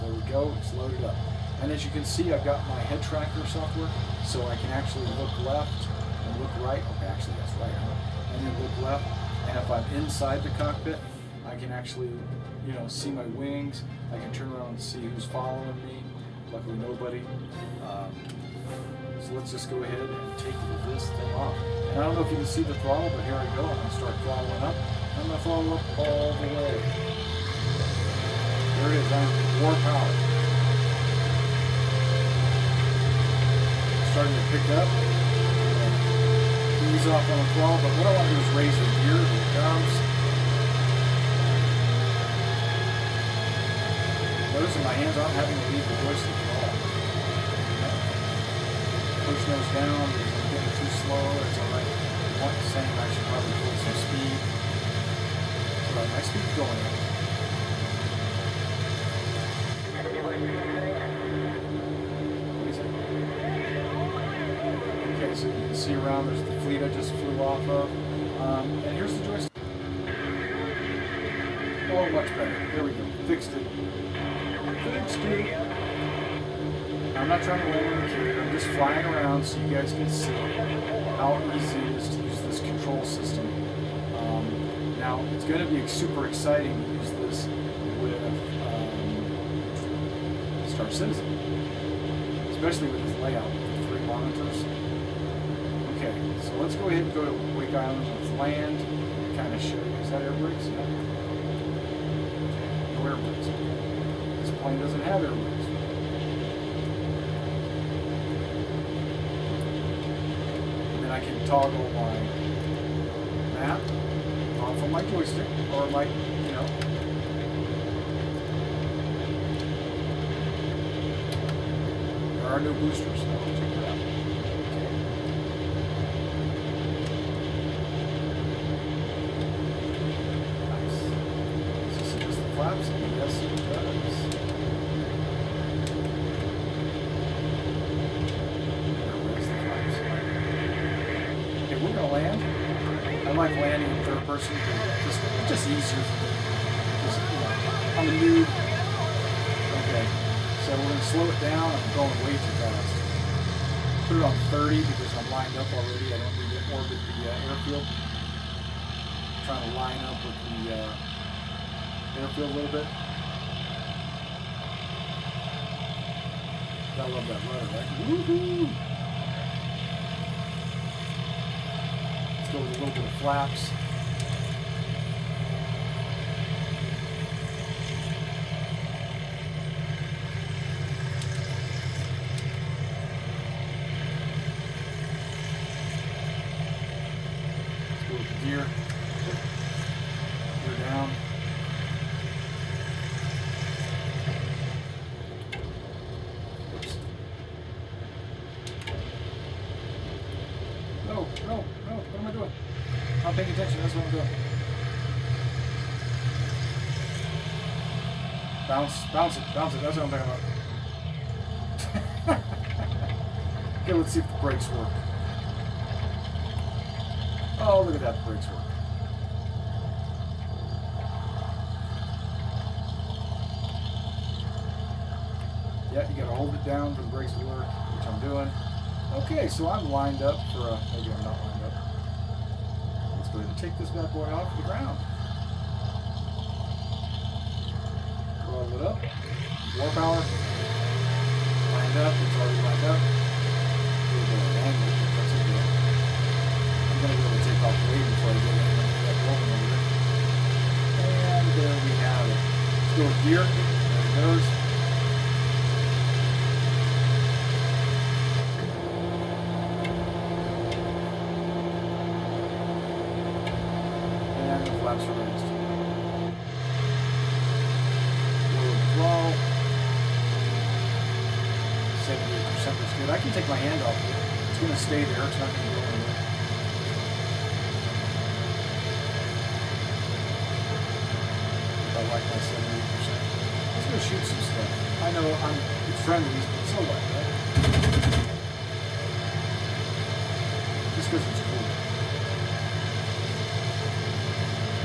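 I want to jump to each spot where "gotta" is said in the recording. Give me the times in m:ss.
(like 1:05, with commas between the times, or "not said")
2:46, 3:46.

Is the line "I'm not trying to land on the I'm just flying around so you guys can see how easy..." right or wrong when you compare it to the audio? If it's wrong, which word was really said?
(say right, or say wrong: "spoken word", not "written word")
right.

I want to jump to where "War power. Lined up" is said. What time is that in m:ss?
3:59.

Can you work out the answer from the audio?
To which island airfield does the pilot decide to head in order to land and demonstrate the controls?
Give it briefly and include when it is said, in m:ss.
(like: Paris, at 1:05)
Wake Island, at 1:37.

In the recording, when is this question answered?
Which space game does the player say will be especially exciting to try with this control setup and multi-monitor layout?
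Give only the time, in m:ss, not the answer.
1:30.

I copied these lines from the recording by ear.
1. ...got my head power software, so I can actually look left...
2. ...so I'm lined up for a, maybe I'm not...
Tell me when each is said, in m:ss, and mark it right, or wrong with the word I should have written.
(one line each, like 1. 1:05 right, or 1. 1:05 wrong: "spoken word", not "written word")
1. 0:02 wrong: "tracker", not "power"
2. 3:49 right.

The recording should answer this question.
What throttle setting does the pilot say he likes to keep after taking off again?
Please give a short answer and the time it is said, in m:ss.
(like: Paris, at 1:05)
70%, at 4:42.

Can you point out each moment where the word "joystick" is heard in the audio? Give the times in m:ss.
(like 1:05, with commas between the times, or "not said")
0:46, 1:09, 1:55.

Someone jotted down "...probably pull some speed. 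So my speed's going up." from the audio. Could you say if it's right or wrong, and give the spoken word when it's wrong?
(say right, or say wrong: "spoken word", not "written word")
right.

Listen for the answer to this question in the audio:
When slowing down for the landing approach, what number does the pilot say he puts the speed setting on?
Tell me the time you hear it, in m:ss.
2:34.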